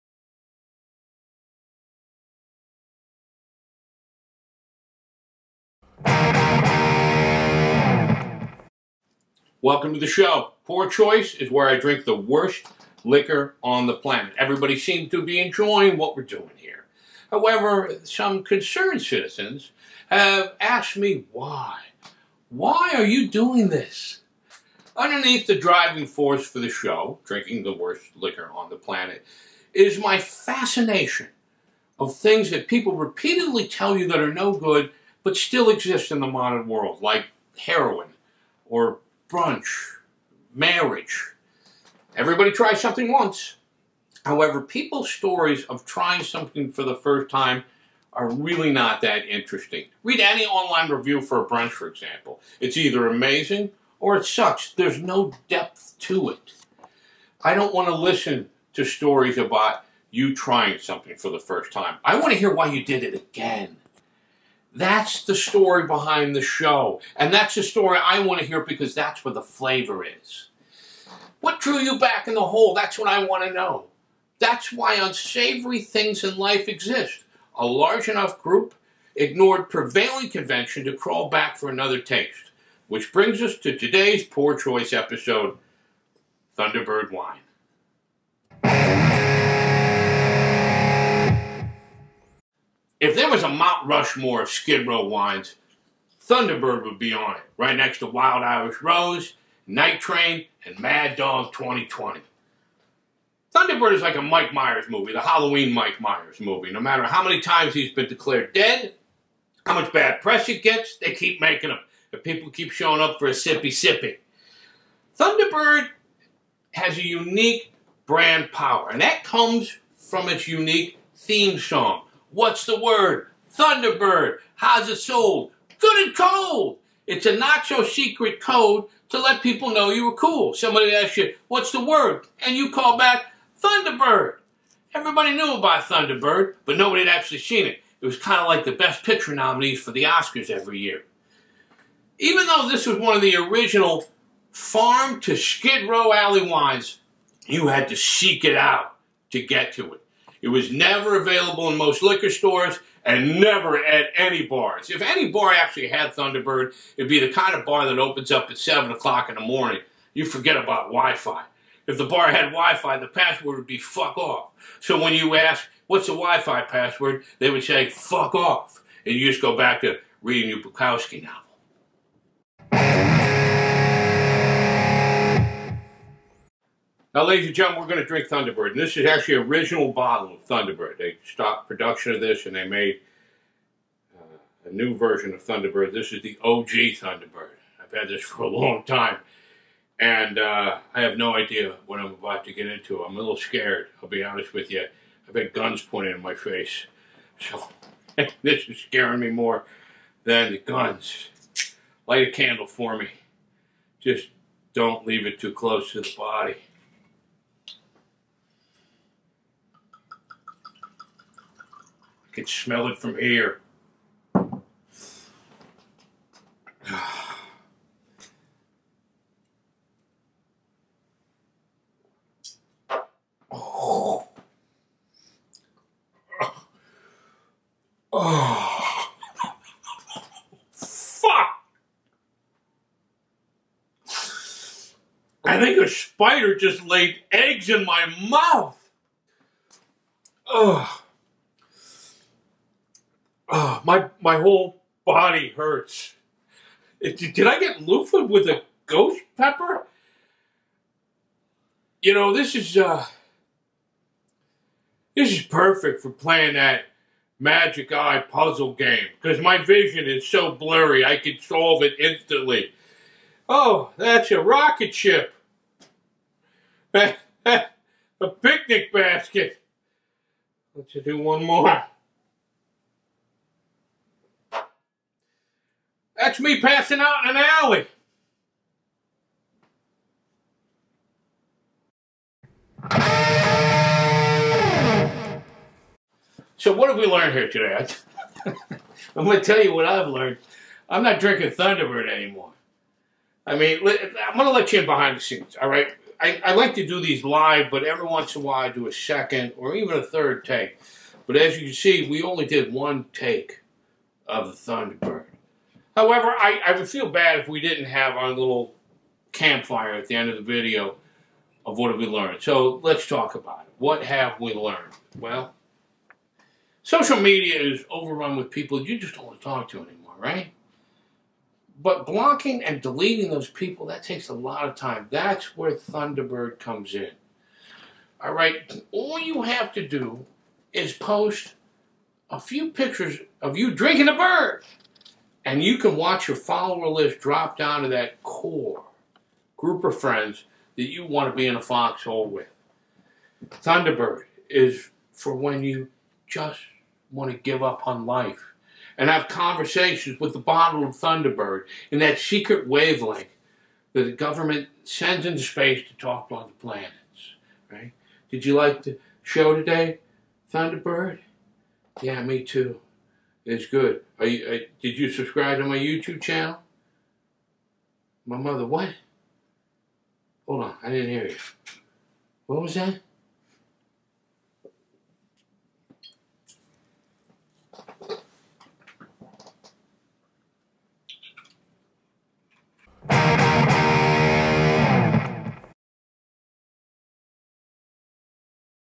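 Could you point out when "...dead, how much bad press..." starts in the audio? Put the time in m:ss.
1:48.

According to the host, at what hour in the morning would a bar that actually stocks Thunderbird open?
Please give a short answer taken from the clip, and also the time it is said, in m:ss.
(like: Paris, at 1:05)
7 o'clock, at 2:38.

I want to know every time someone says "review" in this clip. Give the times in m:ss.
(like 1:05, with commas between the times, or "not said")
0:50.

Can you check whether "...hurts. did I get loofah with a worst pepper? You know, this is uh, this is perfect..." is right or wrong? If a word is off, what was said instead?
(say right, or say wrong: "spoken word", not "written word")
wrong: "ghost", not "worst".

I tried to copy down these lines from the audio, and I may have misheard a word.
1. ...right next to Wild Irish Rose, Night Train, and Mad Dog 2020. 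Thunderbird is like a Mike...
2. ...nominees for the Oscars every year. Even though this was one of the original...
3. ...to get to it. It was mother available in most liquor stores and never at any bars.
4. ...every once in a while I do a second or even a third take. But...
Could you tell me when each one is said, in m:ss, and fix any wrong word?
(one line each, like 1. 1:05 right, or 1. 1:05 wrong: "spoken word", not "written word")
1. 1:37 right
2. 2:19 right
3. 2:29 wrong: "never", not "mother"
4. 4:57 right.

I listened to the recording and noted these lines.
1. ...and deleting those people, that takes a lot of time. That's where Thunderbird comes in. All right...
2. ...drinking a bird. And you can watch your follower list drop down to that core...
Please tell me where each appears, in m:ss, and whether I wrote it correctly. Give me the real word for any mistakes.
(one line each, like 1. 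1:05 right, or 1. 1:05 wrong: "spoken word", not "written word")
1. 5:22 right
2. 5:33 right.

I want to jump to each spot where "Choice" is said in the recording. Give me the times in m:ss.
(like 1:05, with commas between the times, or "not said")
0:10, 1:24.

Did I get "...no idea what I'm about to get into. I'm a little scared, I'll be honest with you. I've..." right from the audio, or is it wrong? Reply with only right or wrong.
right.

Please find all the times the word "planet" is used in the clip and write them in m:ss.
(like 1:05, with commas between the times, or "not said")
0:13, 0:28, 5:56.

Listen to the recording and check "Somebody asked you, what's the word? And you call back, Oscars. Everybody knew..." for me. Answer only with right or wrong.
wrong.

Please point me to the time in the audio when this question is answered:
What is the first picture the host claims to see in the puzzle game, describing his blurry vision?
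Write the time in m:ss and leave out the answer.
4:24.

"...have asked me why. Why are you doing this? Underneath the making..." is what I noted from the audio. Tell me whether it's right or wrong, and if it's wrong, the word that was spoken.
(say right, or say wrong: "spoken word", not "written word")
wrong: "driving", not "making".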